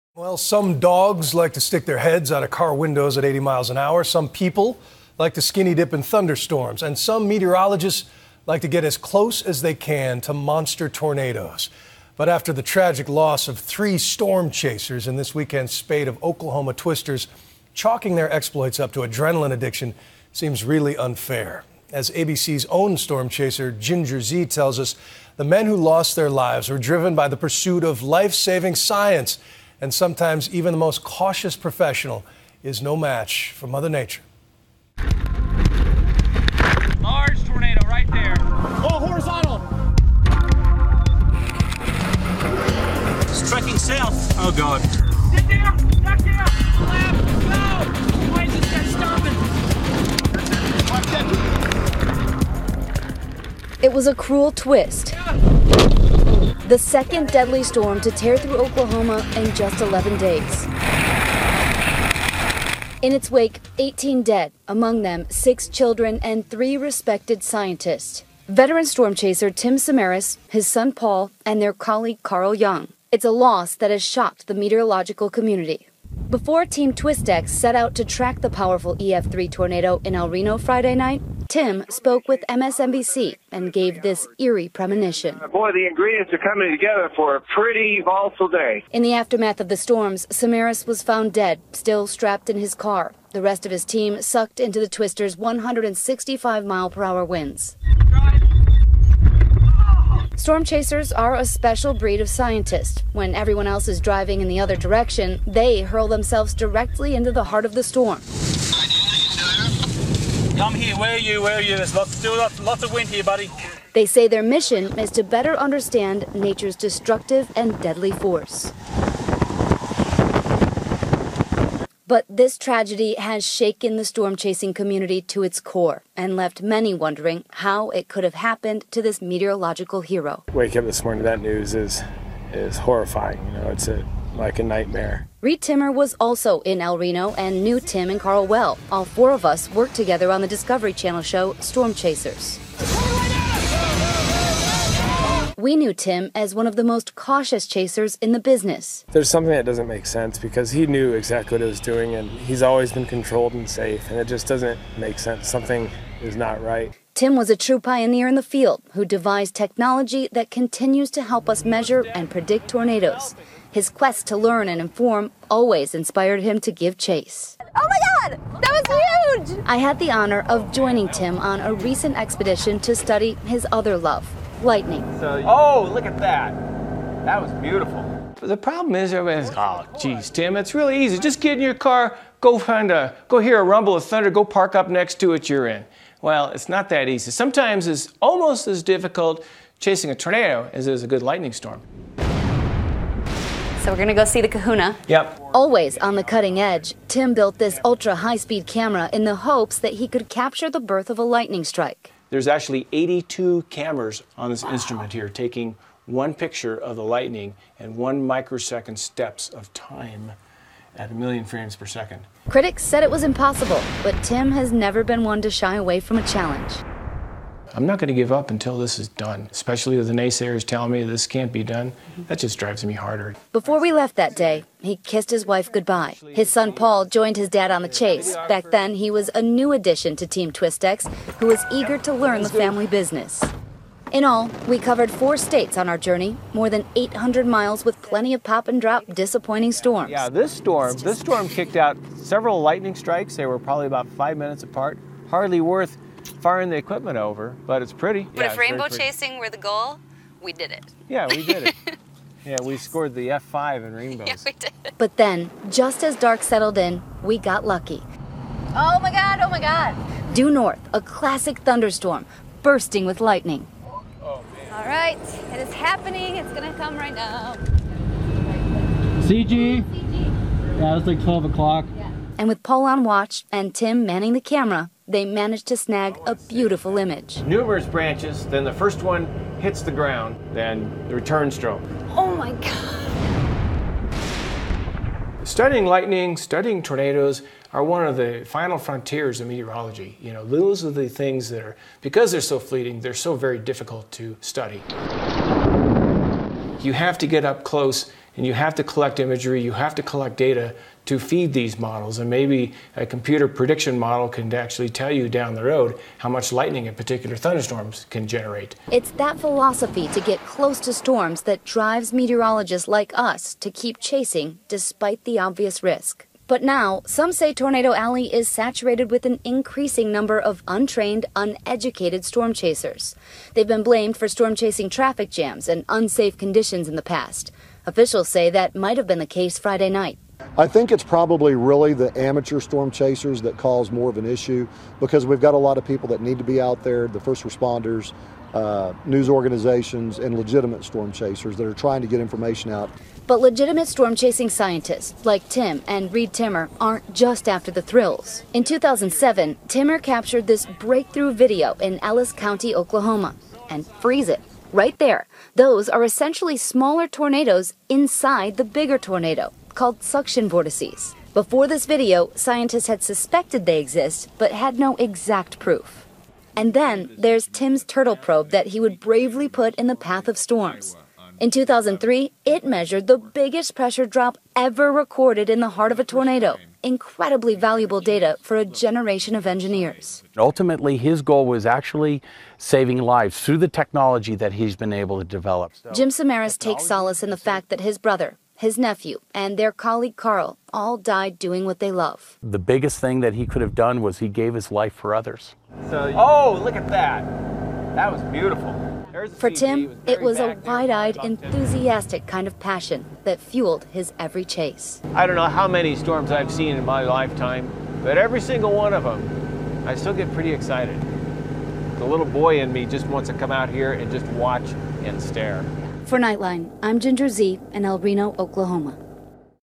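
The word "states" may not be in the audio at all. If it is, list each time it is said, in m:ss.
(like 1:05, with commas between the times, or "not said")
3:55.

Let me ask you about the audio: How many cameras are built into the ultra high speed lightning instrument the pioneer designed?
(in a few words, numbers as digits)
82.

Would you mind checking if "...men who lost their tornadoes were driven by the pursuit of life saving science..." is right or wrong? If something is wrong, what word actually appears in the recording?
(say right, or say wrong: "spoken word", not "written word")
wrong: "lives", not "tornadoes".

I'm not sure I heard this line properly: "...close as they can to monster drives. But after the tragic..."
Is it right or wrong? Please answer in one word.
wrong.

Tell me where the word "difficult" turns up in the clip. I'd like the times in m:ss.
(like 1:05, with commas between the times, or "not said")
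3:08, 4:53.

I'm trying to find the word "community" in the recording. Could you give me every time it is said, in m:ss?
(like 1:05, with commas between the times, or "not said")
1:15, 2:04.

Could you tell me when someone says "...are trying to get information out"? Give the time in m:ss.
5:41.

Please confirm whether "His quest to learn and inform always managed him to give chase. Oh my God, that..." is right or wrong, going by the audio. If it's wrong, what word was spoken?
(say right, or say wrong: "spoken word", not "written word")
wrong: "inspired", not "managed".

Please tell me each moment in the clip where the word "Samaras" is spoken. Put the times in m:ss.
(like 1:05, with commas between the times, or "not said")
1:09, 1:30, 6:26.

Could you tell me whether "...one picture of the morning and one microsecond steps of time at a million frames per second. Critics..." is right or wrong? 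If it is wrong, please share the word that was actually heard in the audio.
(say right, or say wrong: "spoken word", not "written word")
wrong: "lightning", not "morning".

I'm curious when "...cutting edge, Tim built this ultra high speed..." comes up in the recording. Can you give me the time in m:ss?
3:16.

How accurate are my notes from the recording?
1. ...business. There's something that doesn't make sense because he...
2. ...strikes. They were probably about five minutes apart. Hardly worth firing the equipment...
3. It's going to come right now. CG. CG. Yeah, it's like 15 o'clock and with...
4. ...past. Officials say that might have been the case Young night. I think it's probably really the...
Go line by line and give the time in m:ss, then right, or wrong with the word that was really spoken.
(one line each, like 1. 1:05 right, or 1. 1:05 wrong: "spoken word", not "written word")
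1. 2:28 right
2. 4:02 right
3. 4:26 wrong: "12", not "15"
4. 5:27 wrong: "Friday", not "Young".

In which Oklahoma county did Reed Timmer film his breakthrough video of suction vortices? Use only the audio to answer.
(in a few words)
Ellis County.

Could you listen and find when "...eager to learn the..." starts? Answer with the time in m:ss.
3:51.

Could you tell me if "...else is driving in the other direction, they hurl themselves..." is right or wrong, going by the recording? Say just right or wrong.
right.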